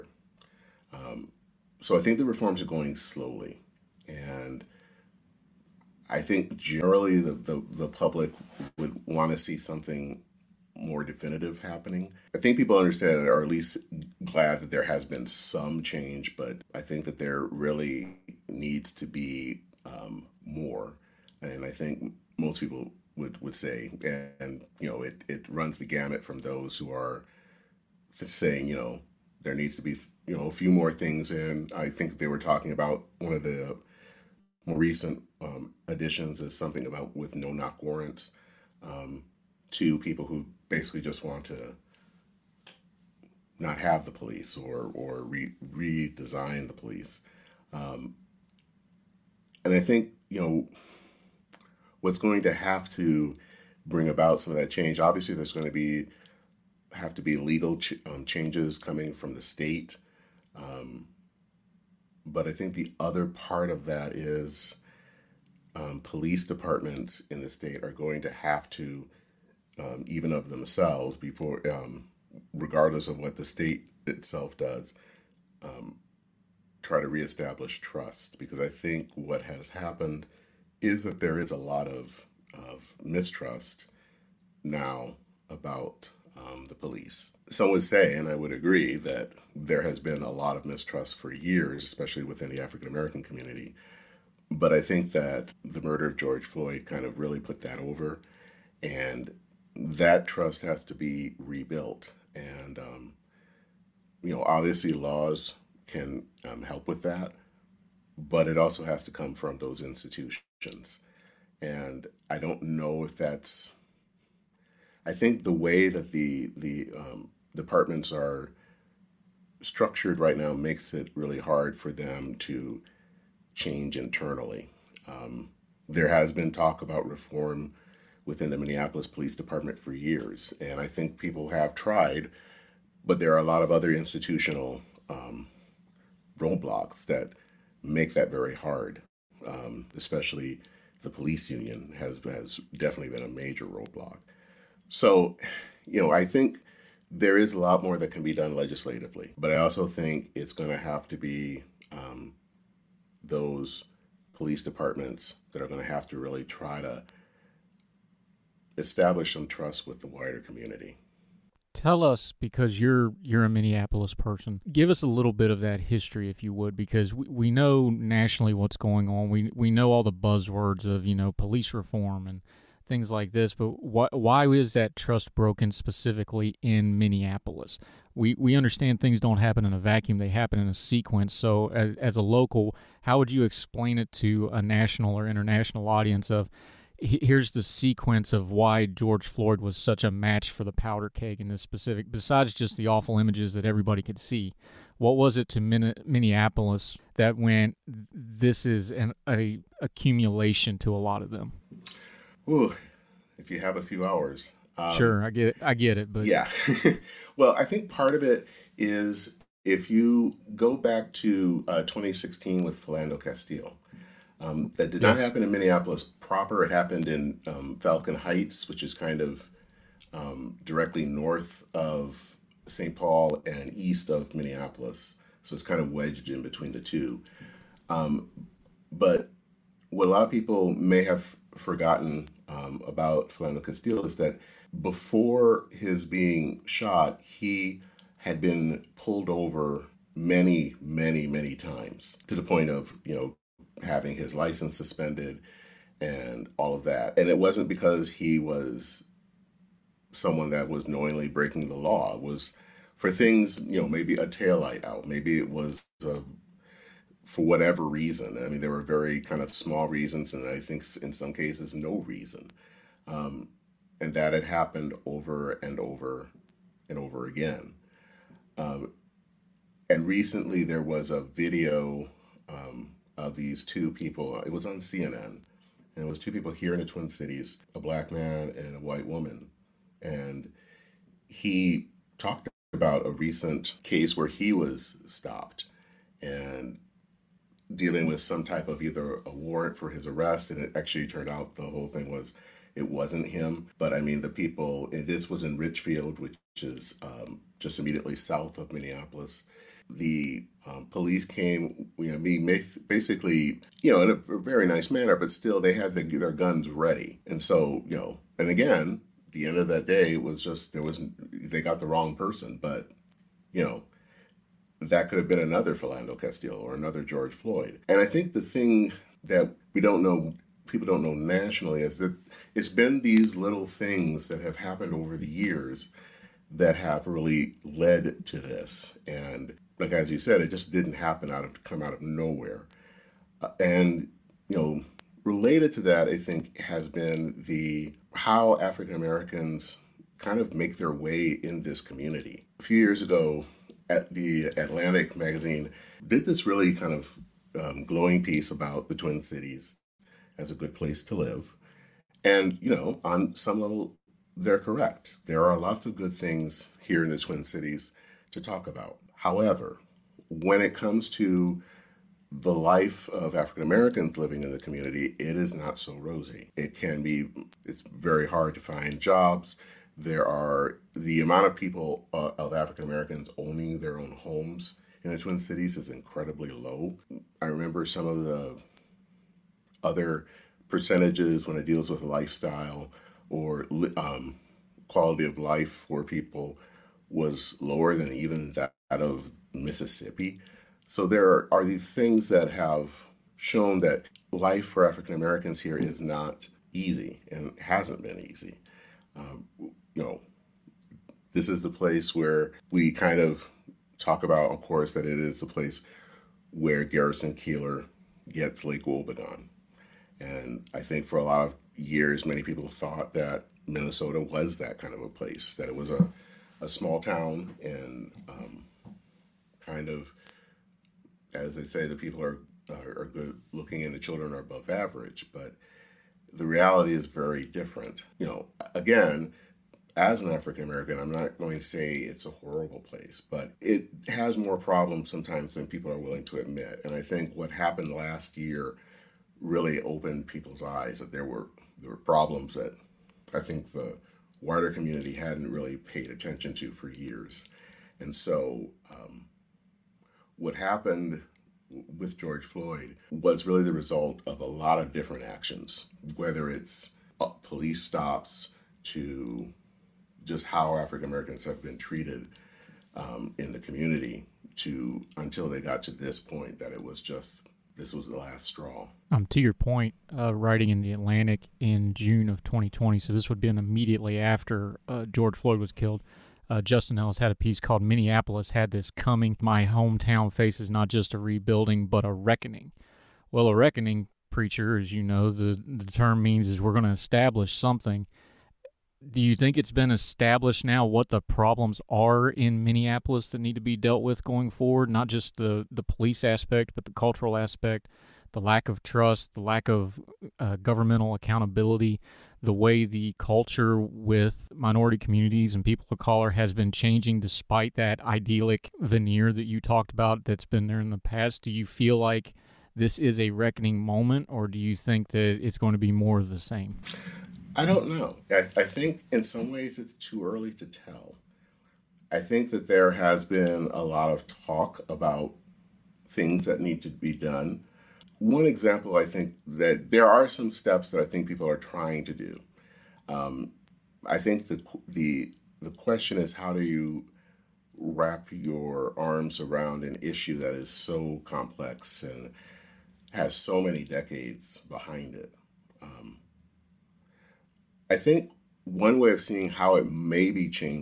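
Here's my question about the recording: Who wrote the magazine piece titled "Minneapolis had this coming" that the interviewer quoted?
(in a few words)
Justin Ellis.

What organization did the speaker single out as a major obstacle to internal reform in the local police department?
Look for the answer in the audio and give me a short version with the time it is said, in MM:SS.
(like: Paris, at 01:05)
the police union, at 02:21.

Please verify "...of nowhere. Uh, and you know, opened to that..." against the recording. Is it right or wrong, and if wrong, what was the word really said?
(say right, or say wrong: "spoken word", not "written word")
wrong: "related", not "opened".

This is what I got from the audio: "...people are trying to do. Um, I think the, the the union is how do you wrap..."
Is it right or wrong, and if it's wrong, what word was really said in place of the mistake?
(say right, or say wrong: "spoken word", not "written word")
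wrong: "question", not "union".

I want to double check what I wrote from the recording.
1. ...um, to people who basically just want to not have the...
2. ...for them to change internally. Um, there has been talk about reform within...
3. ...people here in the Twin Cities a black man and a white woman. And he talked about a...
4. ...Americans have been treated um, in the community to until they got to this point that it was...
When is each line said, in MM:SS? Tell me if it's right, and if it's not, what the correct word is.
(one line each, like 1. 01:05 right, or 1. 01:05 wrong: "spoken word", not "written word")
1. 00:38 right
2. 02:01 right
3. 04:36 right
4. 07:41 right.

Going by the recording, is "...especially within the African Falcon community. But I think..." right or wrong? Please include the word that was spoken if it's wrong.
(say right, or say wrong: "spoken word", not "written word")
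wrong: "American", not "Falcon".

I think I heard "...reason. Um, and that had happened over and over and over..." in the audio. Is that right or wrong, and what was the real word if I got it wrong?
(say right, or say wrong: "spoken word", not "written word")
right.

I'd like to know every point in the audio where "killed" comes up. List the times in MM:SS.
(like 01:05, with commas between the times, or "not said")
07:55.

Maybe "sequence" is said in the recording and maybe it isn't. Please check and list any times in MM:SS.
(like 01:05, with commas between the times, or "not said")
03:00, 03:07.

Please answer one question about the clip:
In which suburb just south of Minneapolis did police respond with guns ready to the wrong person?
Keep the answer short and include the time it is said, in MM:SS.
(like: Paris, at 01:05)
Richfield, at 04:55.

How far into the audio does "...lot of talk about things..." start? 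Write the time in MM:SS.
08:43.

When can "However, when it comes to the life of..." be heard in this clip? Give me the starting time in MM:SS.
05:59.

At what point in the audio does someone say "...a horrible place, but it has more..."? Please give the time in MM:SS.
07:12.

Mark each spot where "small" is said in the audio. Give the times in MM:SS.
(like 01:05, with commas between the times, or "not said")
04:19, 06:56.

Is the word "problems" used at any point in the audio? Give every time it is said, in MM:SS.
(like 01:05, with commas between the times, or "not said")
07:14, 07:21, 08:11.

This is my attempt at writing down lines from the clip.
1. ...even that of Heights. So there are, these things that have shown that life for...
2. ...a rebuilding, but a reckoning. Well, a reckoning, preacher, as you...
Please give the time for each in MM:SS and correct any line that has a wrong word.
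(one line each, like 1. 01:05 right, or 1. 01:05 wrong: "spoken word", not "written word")
1. 06:28 wrong: "Mississippi", not "Heights"
2. 08:01 right.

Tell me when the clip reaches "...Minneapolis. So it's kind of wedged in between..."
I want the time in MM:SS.
03:44.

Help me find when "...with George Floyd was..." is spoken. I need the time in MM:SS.
07:31.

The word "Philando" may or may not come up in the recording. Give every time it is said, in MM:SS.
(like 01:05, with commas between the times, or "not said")
03:32, 03:53, 05:15.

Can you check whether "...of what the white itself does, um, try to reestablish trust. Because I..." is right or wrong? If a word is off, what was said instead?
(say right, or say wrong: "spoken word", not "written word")
wrong: "state", not "white".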